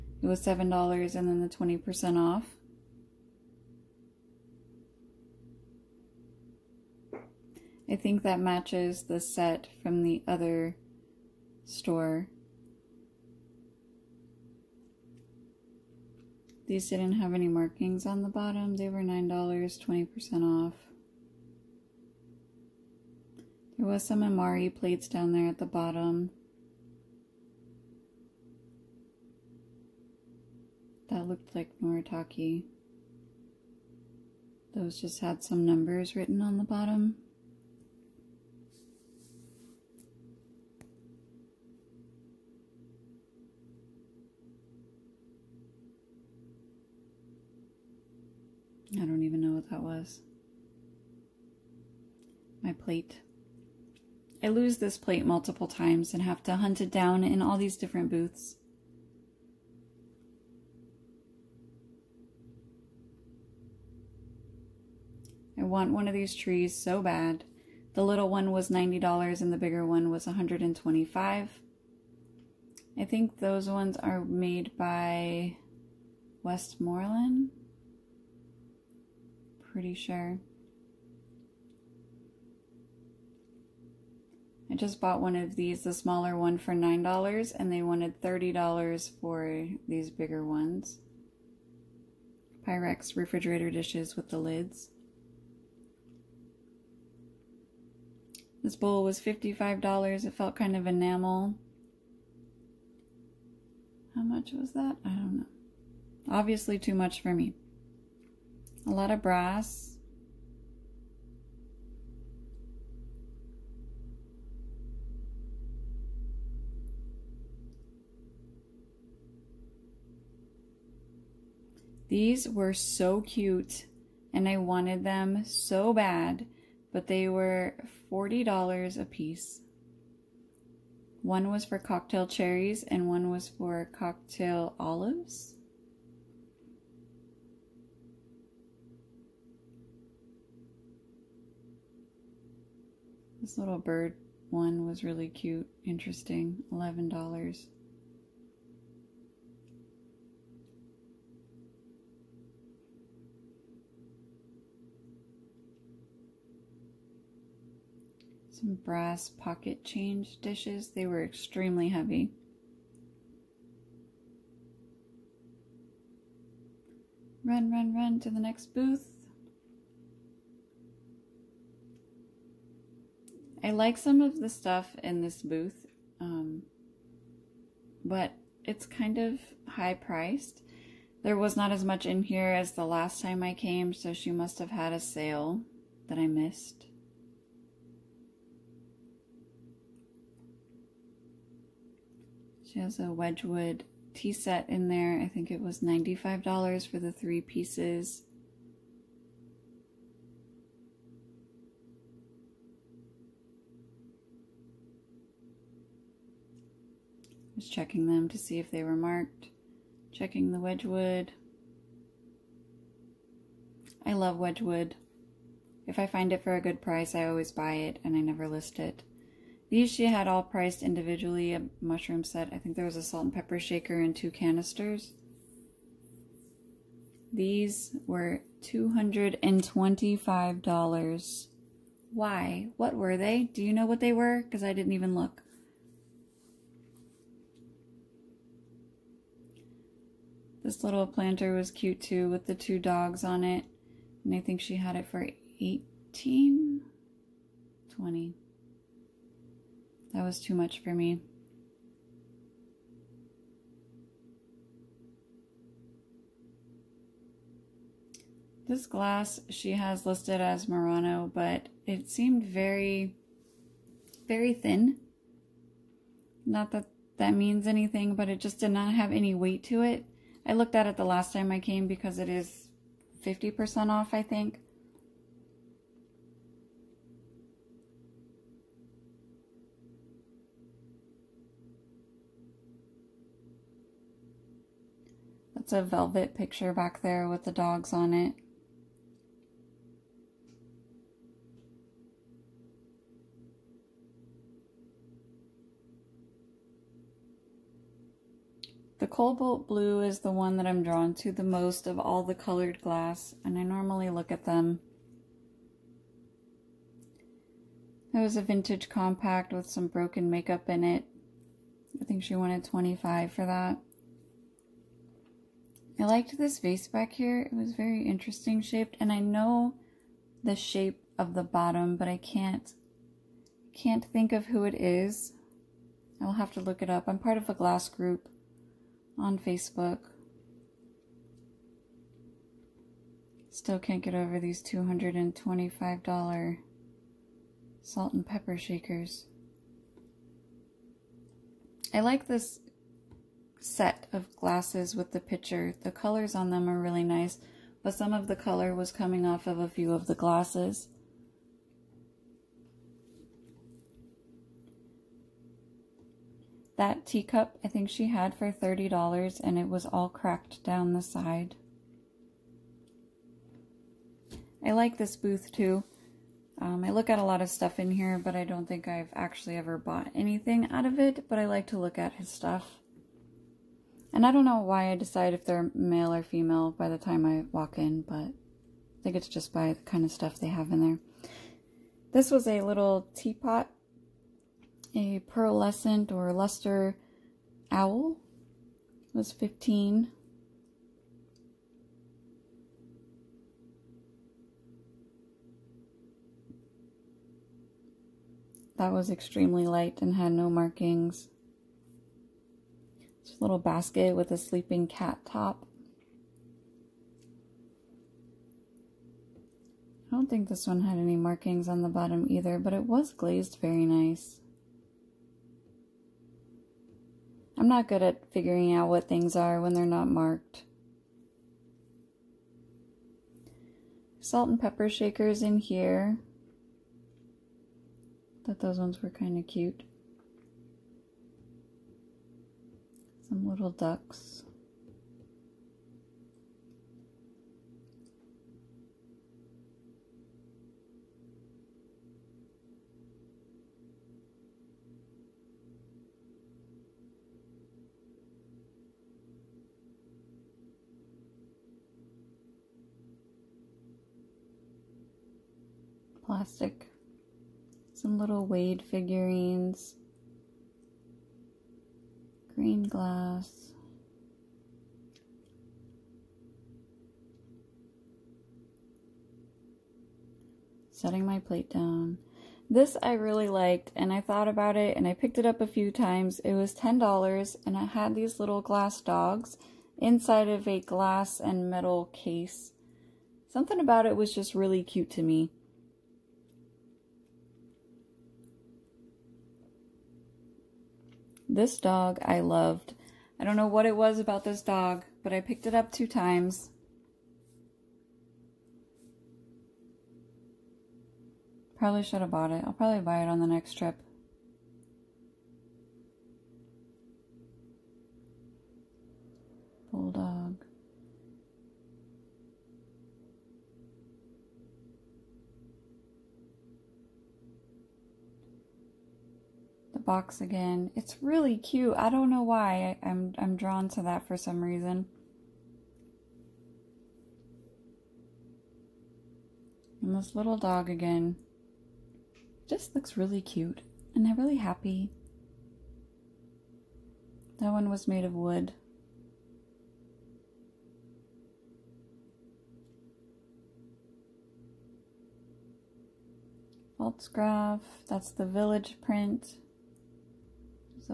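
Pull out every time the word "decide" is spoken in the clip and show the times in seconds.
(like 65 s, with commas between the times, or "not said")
374 s.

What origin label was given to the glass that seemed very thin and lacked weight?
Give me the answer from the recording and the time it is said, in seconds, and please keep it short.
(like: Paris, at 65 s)
Murano, at 260 s.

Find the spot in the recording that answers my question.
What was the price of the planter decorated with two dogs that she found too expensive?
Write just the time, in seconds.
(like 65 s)
245 s.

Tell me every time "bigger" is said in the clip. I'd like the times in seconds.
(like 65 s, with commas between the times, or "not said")
69 s, 90 s.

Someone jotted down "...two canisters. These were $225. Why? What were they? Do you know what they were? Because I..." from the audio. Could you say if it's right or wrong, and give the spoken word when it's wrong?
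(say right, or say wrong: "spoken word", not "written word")
right.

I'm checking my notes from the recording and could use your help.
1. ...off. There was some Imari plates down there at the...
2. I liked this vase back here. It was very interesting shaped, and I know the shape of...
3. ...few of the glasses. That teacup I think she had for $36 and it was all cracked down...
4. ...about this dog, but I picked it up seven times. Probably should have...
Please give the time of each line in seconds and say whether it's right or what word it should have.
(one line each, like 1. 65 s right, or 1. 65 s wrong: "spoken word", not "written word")
1. 20 s right
2. 315 s right
3. 349 s wrong: "30", not "36"
4. 494 s wrong: "two", not "seven".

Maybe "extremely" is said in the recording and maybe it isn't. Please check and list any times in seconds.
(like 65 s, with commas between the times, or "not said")
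161 s, 399 s.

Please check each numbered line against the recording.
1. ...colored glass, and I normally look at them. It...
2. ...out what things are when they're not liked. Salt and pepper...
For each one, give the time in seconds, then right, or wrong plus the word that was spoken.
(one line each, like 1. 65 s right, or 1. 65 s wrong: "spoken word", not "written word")
1. 302 s right
2. 418 s wrong: "marked", not "liked".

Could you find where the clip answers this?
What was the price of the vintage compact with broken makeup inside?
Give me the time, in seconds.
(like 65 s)
312 s.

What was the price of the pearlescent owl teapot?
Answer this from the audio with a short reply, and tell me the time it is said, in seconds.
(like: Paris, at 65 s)
15, at 389 s.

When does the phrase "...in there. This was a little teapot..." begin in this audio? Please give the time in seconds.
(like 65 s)
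380 s.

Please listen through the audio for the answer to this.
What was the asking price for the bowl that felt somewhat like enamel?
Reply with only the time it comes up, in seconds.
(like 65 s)
99 s.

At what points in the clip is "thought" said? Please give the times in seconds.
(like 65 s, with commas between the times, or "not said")
428 s, 474 s.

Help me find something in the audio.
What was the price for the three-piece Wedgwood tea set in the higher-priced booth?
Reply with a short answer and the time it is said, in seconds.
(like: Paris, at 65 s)
$95, at 195 s.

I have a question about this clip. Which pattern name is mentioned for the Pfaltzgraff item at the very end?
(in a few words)
village print.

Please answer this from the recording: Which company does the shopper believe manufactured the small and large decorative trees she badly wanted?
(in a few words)
Westmoreland.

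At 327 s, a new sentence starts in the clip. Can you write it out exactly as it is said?
I'm part of a glass group on Facebook.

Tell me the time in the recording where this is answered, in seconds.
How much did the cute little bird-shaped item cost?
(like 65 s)
146 s.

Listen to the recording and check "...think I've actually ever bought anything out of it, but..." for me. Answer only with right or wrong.
right.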